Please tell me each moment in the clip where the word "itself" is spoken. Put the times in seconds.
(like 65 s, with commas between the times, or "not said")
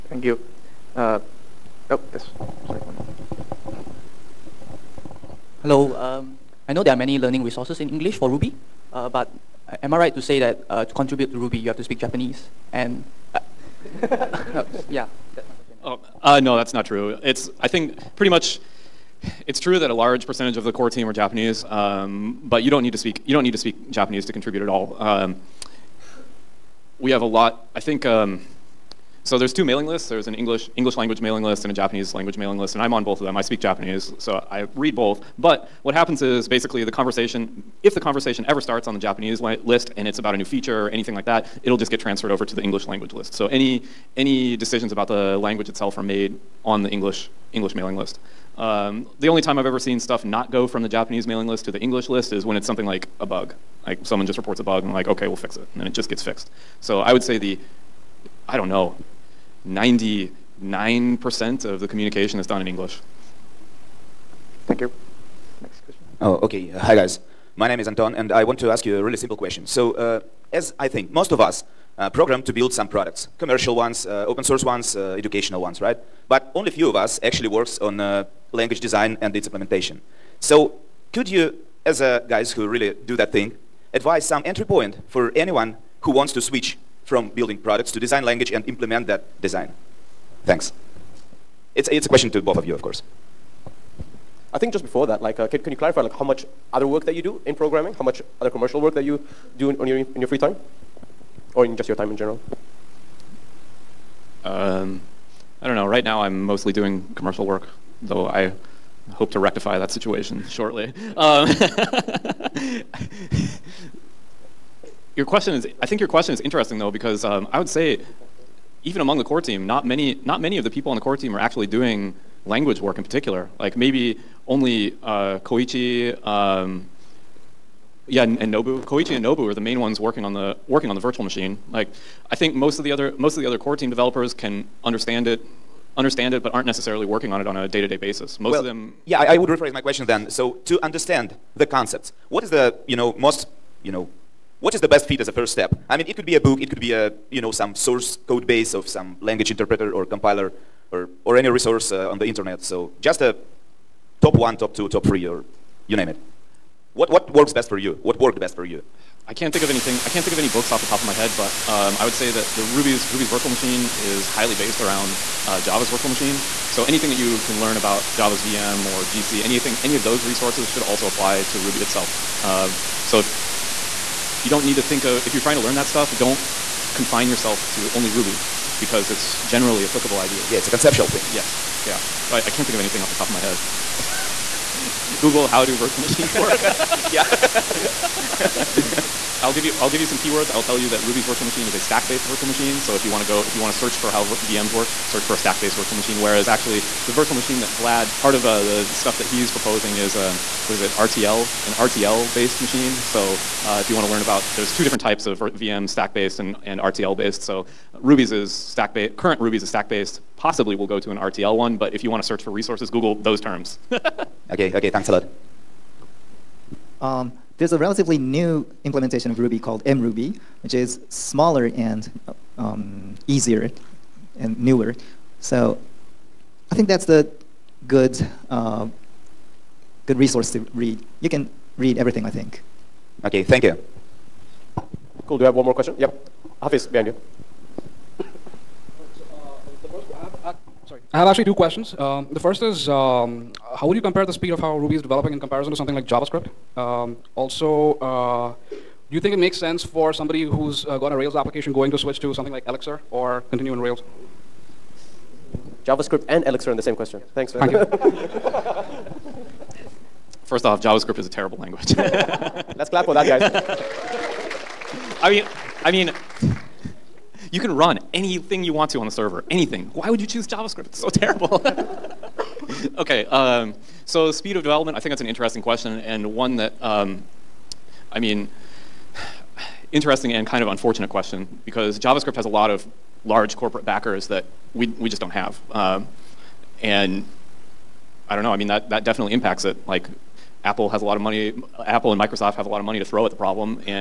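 45 s, 171 s.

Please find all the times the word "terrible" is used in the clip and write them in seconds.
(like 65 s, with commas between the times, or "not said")
261 s, 271 s.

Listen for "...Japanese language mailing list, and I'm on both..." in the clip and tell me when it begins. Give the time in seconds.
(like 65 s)
31 s.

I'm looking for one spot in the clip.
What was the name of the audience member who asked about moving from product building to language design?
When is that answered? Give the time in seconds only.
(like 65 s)
67 s.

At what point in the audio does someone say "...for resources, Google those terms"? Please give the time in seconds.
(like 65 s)
212 s.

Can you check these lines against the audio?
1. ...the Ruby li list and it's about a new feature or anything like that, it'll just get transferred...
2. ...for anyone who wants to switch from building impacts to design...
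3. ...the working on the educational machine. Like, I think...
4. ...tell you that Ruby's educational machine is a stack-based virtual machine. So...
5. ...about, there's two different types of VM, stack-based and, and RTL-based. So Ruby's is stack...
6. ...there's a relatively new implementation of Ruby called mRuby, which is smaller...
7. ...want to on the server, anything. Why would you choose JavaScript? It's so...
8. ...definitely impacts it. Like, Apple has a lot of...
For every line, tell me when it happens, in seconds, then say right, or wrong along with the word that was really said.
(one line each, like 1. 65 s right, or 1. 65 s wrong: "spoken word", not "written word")
1. 38 s wrong: "Japanese", not "Ruby"
2. 85 s wrong: "products", not "impacts"
3. 130 s wrong: "virtual", not "educational"
4. 190 s wrong: "virtual", not "educational"
5. 204 s right
6. 217 s right
7. 268 s right
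8. 289 s right.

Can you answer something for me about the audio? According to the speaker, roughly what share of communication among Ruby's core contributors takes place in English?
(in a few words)
99%.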